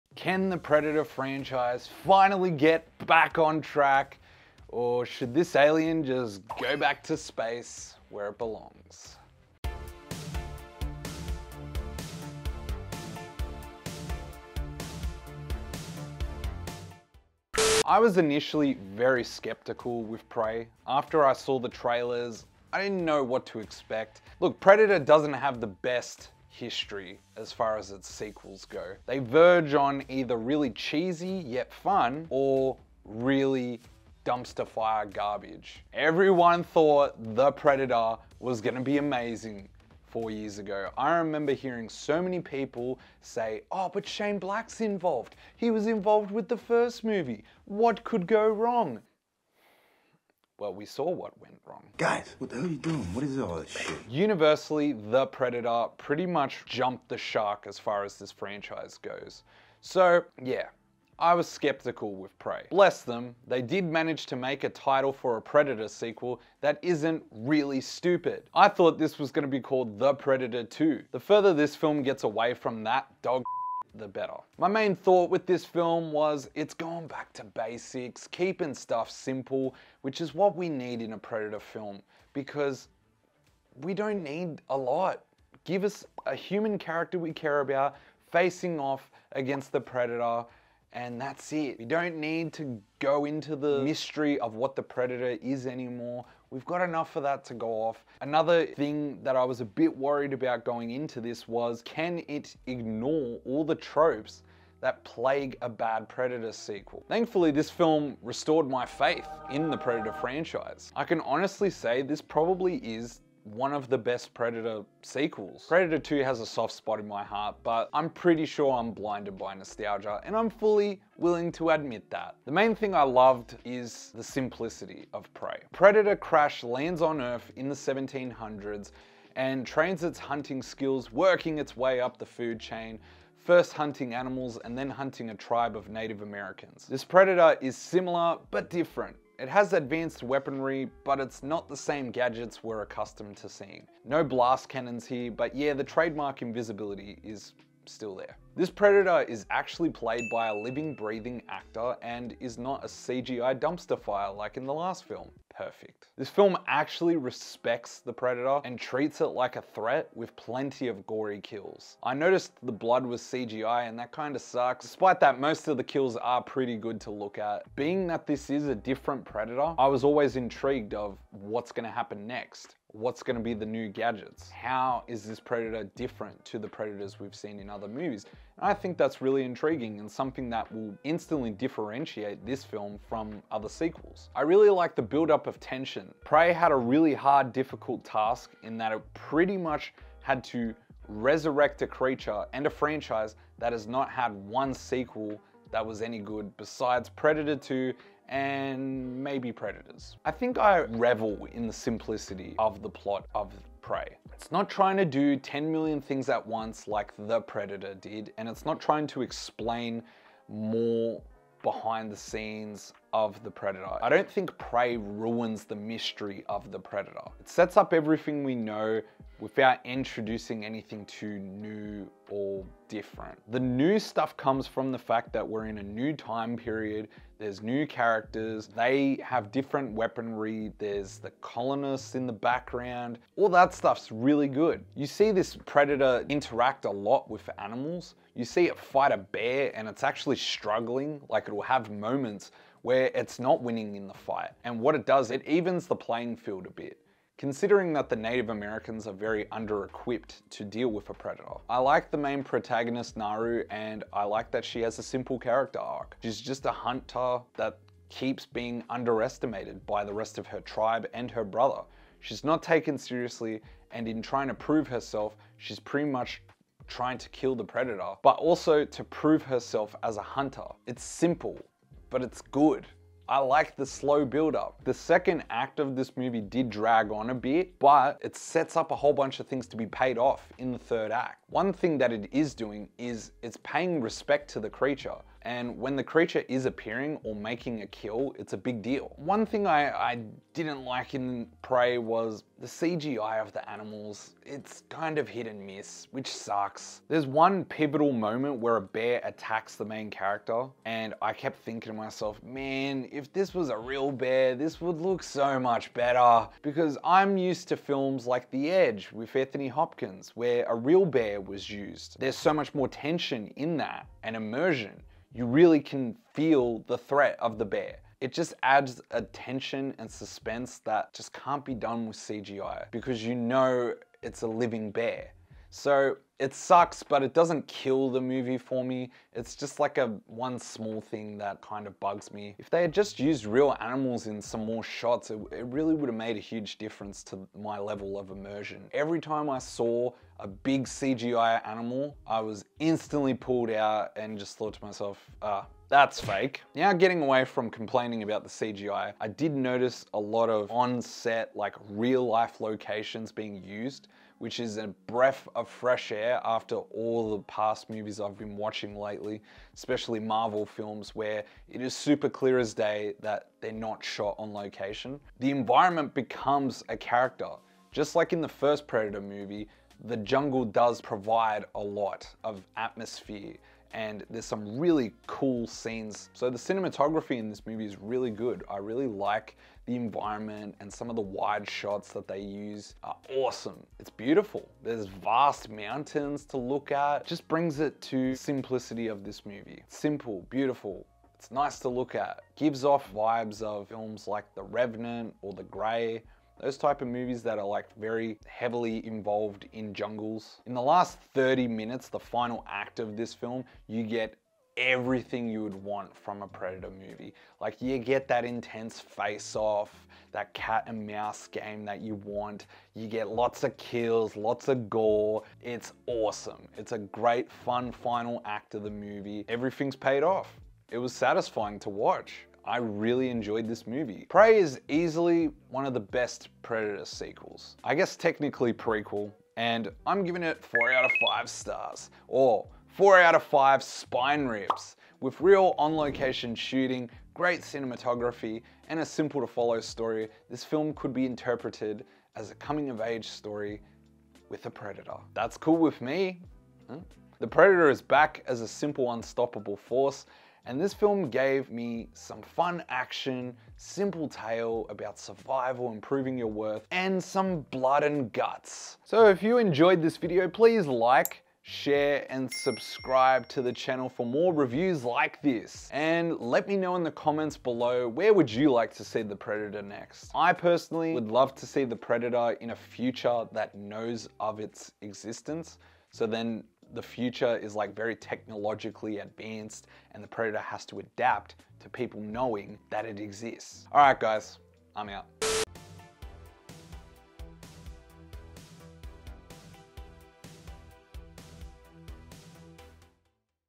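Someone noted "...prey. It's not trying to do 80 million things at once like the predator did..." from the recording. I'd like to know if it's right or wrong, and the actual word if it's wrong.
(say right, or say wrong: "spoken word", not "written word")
wrong: "10", not "80".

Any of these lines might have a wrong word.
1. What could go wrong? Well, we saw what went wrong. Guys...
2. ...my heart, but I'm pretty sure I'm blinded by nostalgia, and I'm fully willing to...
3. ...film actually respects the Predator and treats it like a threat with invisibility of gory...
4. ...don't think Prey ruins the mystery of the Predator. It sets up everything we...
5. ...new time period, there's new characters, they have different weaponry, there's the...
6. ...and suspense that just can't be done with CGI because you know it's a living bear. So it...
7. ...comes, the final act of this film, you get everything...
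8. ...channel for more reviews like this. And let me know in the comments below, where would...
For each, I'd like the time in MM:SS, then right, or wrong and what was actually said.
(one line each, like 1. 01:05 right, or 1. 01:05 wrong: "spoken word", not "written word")
1. 00:47 right
2. 01:57 right
3. 02:36 wrong: "plenty", not "invisibility"
4. 03:34 right
5. 03:45 right
6. 05:19 right
7. 06:41 wrong: "minutes", not "comes"
8. 07:43 right.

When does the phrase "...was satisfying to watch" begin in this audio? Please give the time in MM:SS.
07:00.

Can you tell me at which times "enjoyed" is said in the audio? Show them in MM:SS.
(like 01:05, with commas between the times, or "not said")
07:03, 07:39.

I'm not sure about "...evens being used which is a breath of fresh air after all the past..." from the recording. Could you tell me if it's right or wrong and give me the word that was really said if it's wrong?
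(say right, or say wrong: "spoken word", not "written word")
wrong: "locations", not "evens".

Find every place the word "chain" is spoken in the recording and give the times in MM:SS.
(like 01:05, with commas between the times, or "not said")
02:12.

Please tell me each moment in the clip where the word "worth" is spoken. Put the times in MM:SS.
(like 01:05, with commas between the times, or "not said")
07:36.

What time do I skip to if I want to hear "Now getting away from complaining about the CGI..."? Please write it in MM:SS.
05:46.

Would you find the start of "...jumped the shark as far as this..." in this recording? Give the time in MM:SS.
00:56.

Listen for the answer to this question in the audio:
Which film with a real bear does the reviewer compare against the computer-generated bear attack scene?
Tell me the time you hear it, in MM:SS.
05:08.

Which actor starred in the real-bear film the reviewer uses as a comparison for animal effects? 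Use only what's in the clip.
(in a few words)
Anthony Hopkins.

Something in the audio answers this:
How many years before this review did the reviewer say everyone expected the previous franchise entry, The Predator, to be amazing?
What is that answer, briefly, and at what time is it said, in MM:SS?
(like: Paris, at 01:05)
4, at 00:40.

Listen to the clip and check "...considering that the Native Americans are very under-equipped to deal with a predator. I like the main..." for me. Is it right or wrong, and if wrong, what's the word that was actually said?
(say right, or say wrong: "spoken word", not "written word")
right.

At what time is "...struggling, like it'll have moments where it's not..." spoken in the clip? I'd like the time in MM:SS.
04:00.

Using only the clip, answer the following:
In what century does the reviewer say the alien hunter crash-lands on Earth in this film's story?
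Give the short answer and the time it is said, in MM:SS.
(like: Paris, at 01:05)
1700s, at 02:07.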